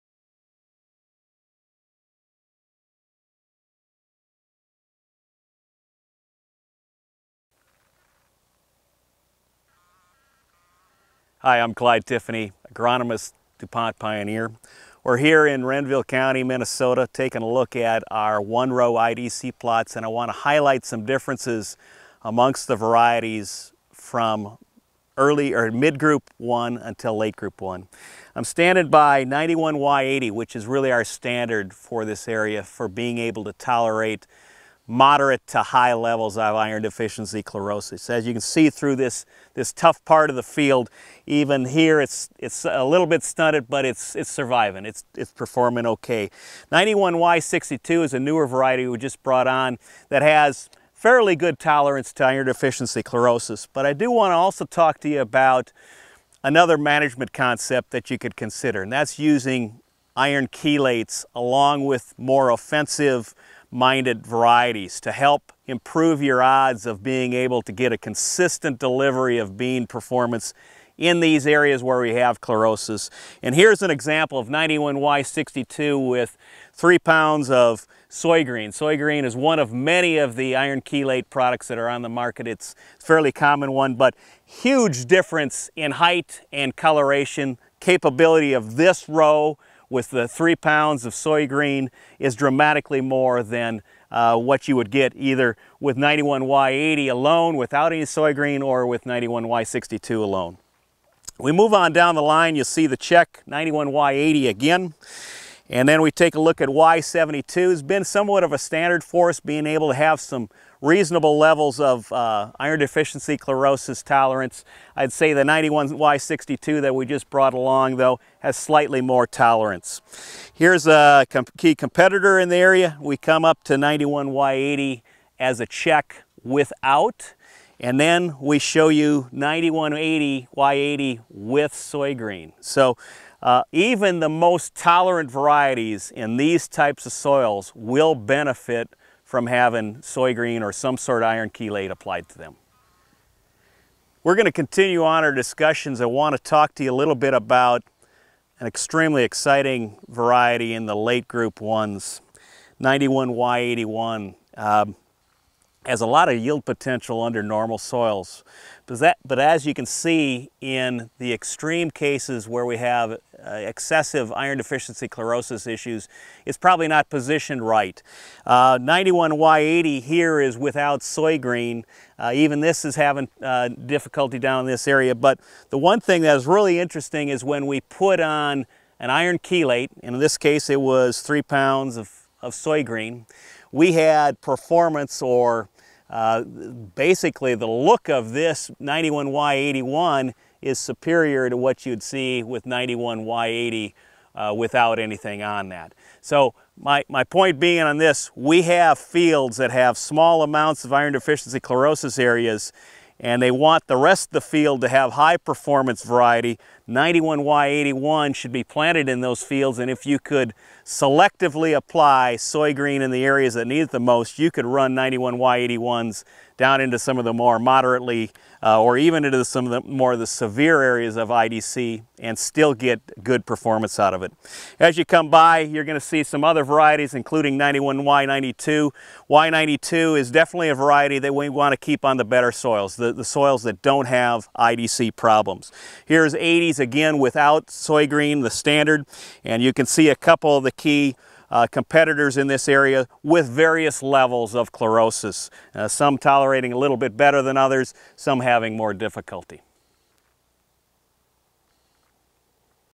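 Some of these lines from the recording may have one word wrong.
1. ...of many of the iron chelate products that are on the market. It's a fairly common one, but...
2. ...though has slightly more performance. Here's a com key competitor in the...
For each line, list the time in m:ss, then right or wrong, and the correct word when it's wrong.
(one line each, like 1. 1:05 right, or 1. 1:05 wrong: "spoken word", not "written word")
1. 1:19 right
2. 1:57 wrong: "tolerance", not "performance".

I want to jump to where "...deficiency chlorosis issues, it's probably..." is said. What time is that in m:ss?
2:44.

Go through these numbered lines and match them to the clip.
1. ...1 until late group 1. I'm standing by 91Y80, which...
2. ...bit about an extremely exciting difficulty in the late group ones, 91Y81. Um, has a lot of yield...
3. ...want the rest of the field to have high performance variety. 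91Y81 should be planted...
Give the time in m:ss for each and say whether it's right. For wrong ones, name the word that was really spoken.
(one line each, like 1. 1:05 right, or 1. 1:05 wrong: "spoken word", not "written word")
1. 0:26 right
2. 2:27 wrong: "variety", not "difficulty"
3. 3:23 right.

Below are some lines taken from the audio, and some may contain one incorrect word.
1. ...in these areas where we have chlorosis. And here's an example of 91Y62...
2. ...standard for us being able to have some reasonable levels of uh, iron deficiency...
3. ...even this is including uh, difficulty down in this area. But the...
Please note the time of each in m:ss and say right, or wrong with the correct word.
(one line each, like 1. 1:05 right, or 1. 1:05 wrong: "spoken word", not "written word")
1. 1:10 right
2. 1:48 right
3. 2:52 wrong: "having", not "including".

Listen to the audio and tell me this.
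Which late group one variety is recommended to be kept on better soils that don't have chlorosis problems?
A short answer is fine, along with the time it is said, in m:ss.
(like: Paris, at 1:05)
91Y92, at 3:47.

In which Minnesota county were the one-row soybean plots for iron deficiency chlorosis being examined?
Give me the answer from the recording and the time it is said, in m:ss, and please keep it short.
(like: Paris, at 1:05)
Renville County, at 0:15.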